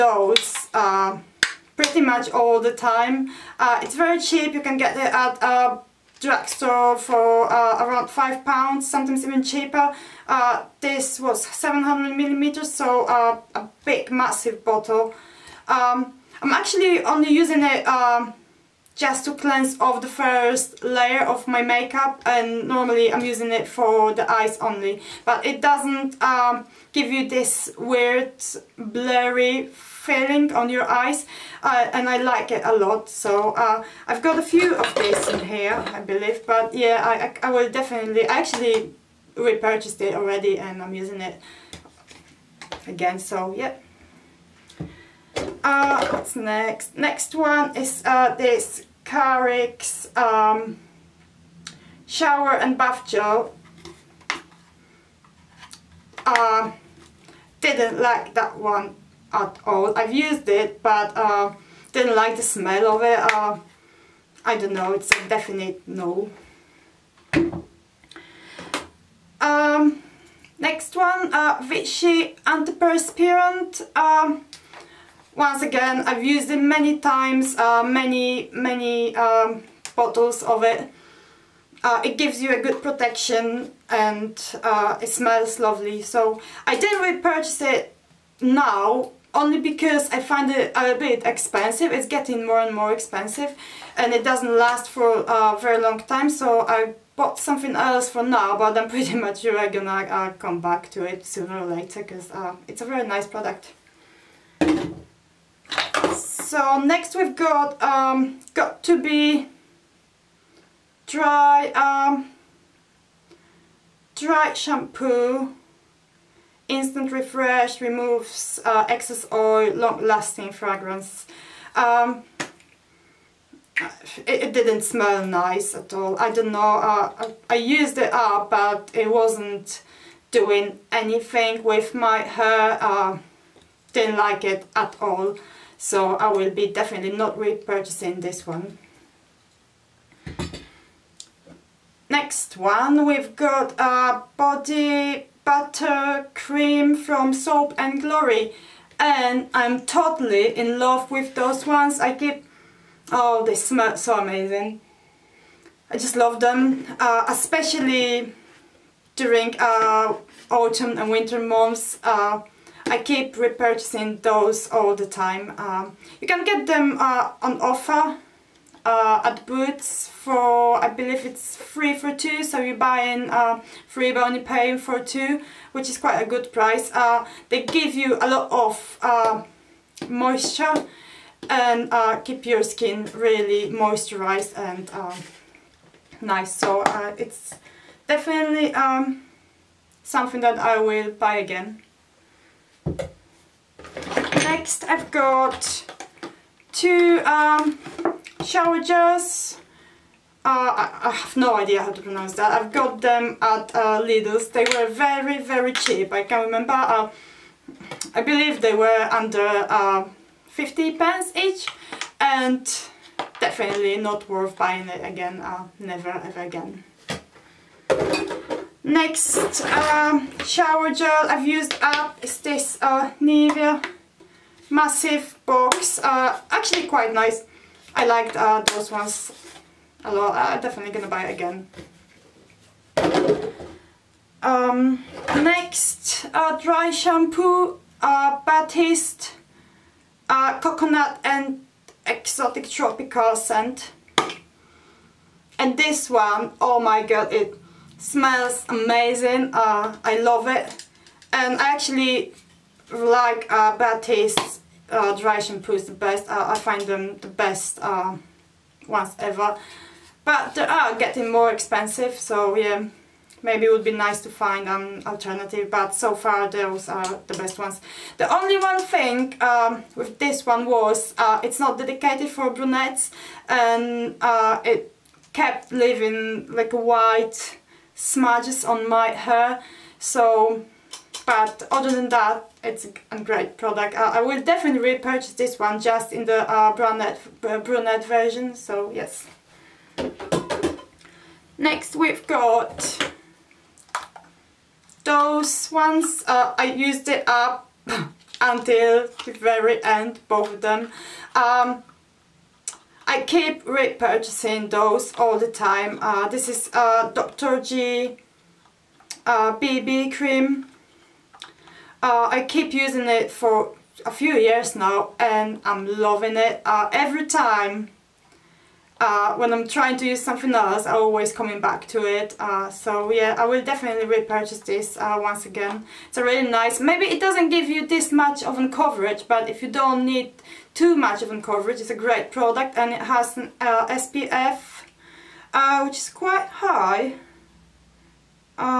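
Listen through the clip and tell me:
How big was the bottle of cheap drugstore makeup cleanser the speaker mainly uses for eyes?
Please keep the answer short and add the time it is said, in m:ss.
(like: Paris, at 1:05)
700 millimeters, at 0:11.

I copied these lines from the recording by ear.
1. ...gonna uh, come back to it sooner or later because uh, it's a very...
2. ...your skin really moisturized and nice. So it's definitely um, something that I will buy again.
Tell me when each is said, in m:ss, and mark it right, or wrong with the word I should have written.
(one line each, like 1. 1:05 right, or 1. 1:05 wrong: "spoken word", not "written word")
1. 1:39 right
2. 3:02 right.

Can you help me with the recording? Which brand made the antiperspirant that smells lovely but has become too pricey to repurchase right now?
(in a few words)
Vichy.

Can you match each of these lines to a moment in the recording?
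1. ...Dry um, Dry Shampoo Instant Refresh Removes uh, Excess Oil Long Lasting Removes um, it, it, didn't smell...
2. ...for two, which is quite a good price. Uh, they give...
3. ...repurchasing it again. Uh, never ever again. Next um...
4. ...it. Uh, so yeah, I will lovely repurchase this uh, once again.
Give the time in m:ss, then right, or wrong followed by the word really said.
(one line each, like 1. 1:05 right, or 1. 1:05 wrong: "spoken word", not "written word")
1. 1:51 wrong: "Fragrance", not "Removes"
2. 2:54 right
3. 3:34 wrong: "buying", not "repurchasing"
4. 5:22 wrong: "definitely", not "lovely".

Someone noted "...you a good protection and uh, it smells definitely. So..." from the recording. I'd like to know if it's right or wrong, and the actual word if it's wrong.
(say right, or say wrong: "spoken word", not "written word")
wrong: "lovely", not "definitely".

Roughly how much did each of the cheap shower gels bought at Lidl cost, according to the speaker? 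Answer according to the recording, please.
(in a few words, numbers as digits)
under 50 pence.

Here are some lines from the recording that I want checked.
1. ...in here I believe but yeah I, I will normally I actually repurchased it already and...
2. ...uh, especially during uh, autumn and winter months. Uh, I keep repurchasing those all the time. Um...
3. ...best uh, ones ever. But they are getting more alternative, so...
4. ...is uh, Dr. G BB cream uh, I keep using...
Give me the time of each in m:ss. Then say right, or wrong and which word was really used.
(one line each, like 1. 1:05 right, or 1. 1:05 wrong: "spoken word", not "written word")
1. 0:35 wrong: "definitely", not "normally"
2. 2:36 right
3. 4:17 wrong: "expensive", not "alternative"
4. 5:06 right.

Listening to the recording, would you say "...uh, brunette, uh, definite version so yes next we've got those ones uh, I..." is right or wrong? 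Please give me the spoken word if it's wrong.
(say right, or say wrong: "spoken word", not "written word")
wrong: "brunette", not "definite".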